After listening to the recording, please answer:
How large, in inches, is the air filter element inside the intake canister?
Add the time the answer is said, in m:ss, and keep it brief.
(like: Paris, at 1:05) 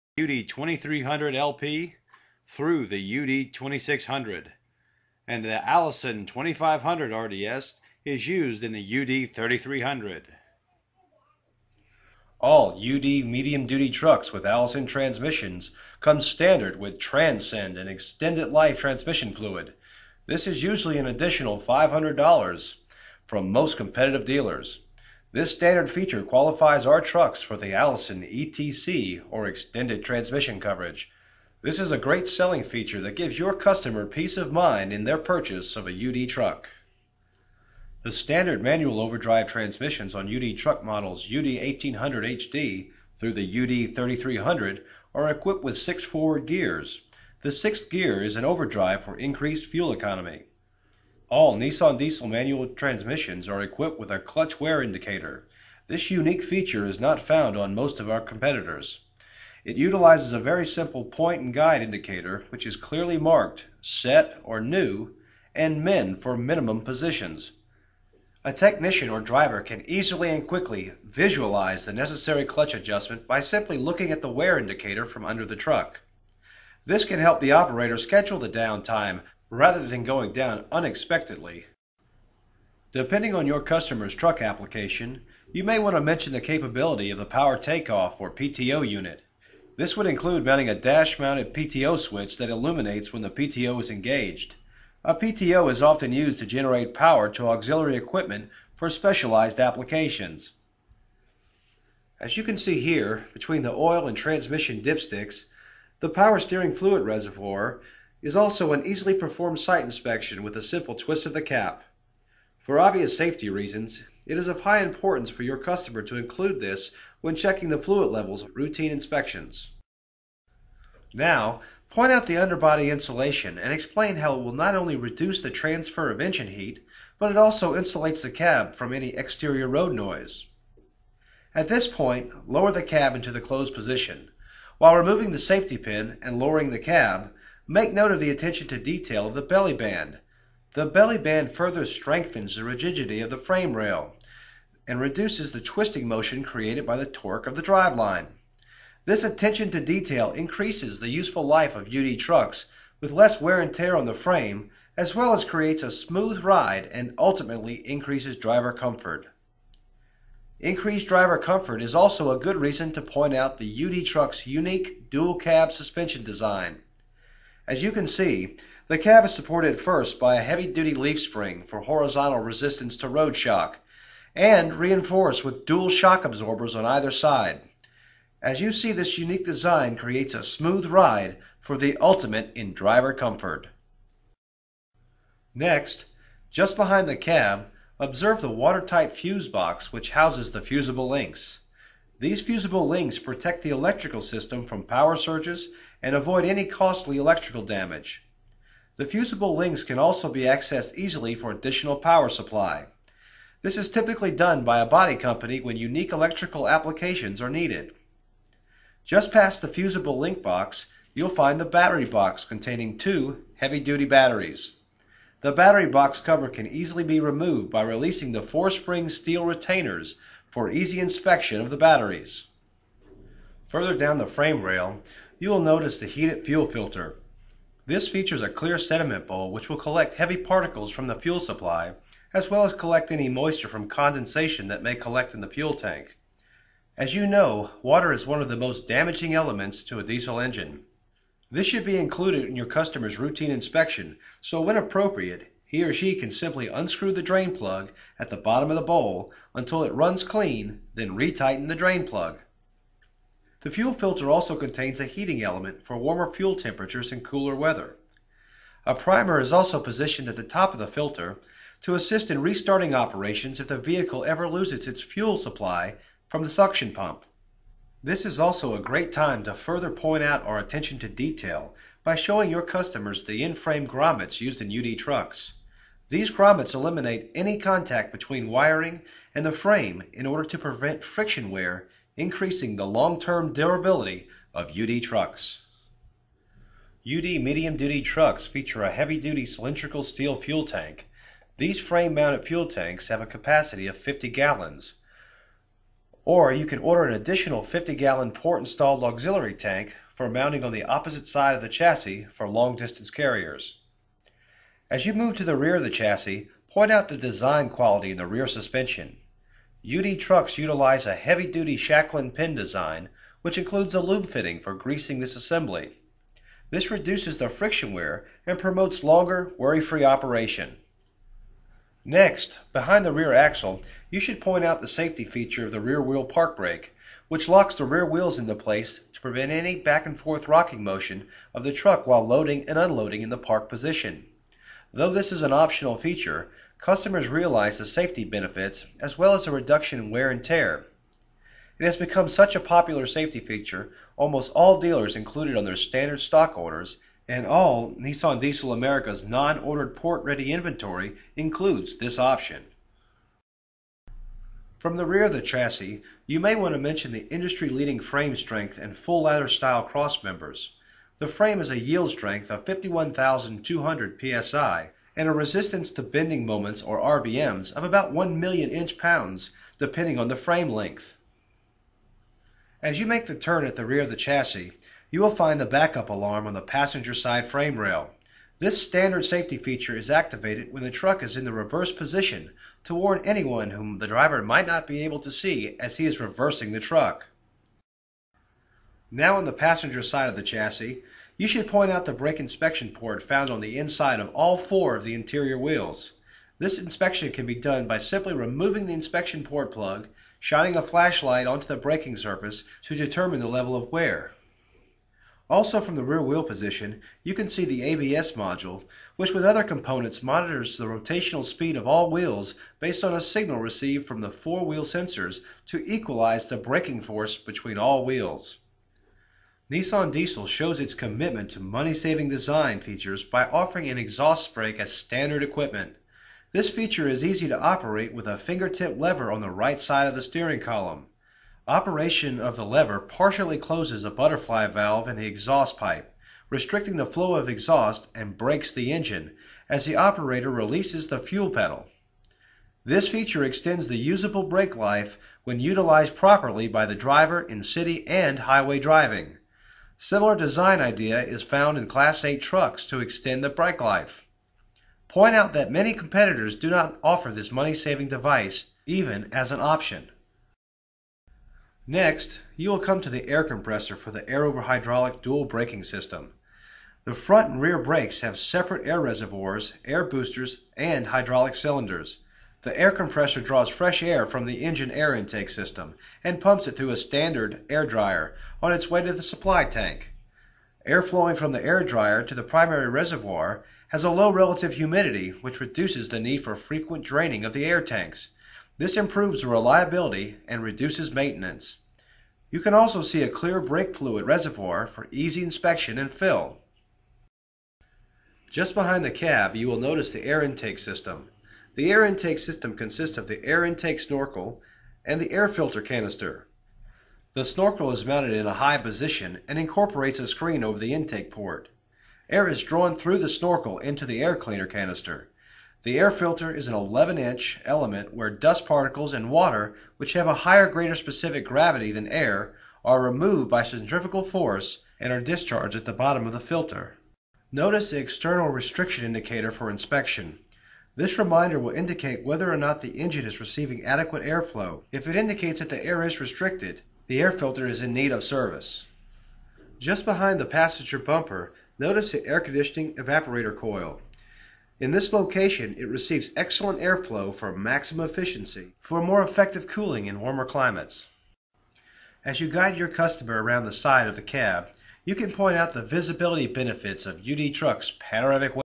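11 inch, at 8:36.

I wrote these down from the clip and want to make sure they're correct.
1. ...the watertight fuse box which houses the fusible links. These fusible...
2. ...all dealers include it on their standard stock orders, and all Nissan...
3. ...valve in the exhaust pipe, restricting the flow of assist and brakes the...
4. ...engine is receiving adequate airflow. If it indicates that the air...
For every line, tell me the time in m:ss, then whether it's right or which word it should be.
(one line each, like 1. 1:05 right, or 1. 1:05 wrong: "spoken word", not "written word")
1. 3:08 right
2. 5:44 right
3. 7:14 wrong: "exhaust", not "assist"
4. 8:52 right.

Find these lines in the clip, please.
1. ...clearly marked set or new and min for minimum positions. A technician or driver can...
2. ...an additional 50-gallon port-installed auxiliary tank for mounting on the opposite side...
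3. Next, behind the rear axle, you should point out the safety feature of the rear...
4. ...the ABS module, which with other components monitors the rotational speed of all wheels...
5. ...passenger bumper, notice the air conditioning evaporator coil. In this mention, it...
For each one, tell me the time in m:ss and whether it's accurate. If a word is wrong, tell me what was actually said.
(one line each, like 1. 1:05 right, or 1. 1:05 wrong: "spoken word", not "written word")
1. 1:02 right
2. 4:57 right
3. 5:22 right
4. 6:47 right
5. 9:00 wrong: "location", not "mention".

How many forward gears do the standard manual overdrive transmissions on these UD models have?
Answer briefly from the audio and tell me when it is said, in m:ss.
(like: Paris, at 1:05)
6, at 0:45.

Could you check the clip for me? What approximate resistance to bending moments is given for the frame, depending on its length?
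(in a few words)
1 million inch pounds.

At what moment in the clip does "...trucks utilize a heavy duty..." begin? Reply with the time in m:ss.
5:10.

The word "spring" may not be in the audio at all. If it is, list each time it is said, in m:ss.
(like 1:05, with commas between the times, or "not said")
2:51, 3:38.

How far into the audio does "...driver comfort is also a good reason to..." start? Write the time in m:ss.
2:41.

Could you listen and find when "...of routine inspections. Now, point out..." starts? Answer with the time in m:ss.
1:58.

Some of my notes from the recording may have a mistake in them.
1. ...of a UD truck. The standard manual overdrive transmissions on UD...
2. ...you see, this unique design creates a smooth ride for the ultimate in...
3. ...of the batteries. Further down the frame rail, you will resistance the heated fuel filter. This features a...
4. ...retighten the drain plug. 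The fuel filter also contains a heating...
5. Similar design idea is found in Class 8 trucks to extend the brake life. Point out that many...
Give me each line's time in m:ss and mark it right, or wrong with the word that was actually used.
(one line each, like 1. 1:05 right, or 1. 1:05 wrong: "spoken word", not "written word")
1. 0:35 right
2. 2:58 right
3. 3:41 wrong: "notice", not "resistance"
4. 4:11 right
5. 7:30 right.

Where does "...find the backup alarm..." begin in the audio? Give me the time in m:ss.
6:15.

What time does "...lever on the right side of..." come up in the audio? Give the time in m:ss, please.
7:08.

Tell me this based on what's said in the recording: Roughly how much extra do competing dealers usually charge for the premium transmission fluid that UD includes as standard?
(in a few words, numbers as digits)
$500.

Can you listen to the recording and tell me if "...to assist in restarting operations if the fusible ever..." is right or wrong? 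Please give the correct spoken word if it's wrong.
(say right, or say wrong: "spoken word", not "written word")
wrong: "vehicle", not "fusible".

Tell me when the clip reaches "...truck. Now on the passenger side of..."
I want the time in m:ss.
6:26.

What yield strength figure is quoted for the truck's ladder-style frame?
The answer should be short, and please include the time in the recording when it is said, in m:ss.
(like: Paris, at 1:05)
51,200 psi, at 6:02.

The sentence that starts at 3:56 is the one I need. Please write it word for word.
As you know, water is one of the most damaging elements to a diesel engine.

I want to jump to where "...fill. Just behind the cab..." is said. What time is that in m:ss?
8:16.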